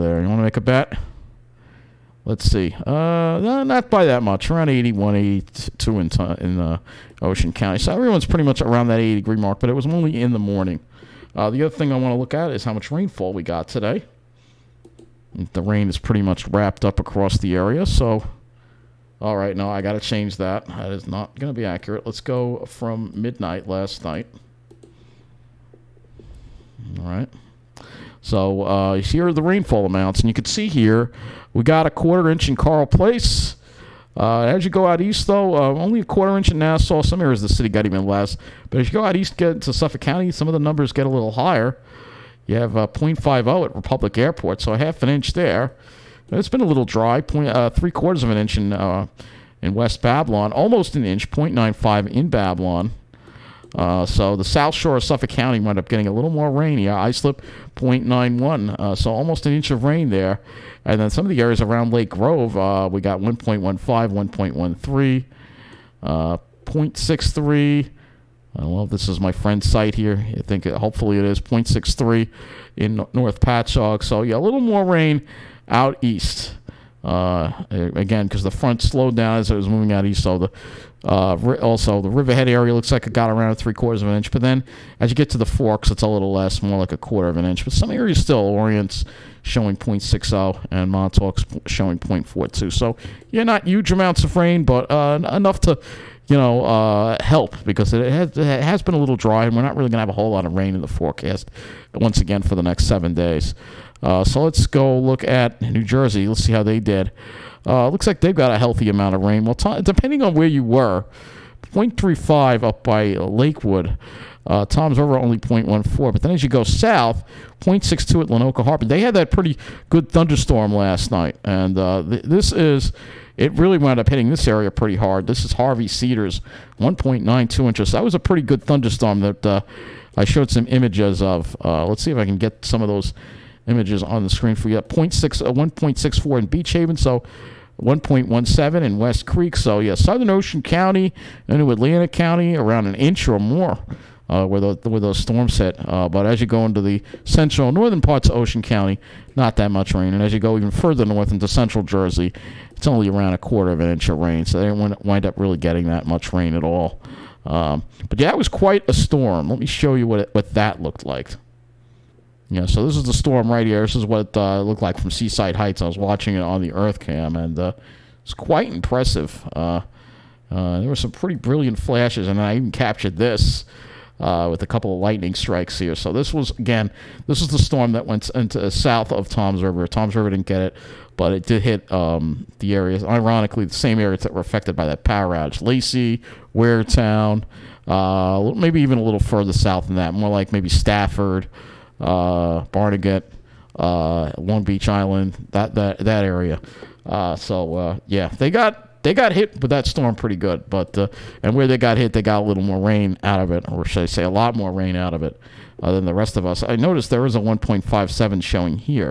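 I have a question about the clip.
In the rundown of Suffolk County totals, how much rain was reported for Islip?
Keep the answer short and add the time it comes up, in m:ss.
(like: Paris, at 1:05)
0.91, at 0:56.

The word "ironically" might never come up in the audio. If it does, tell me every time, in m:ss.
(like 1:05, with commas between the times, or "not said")
3:03.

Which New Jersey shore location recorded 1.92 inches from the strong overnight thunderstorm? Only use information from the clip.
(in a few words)
Harvey Cedars.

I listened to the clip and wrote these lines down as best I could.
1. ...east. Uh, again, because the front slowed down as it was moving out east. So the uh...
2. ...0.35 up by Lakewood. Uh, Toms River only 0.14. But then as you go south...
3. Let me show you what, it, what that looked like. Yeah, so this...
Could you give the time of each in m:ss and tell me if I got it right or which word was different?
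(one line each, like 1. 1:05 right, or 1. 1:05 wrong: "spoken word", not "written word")
1. 1:16 right
2. 1:51 right
3. 2:39 right.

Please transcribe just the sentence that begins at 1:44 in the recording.
Uh, so let's go look at New Jersey.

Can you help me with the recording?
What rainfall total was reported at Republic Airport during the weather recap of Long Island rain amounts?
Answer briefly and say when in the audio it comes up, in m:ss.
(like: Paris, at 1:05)
0.50 inches, at 0:42.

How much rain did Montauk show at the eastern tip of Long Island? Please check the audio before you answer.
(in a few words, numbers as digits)
0.42.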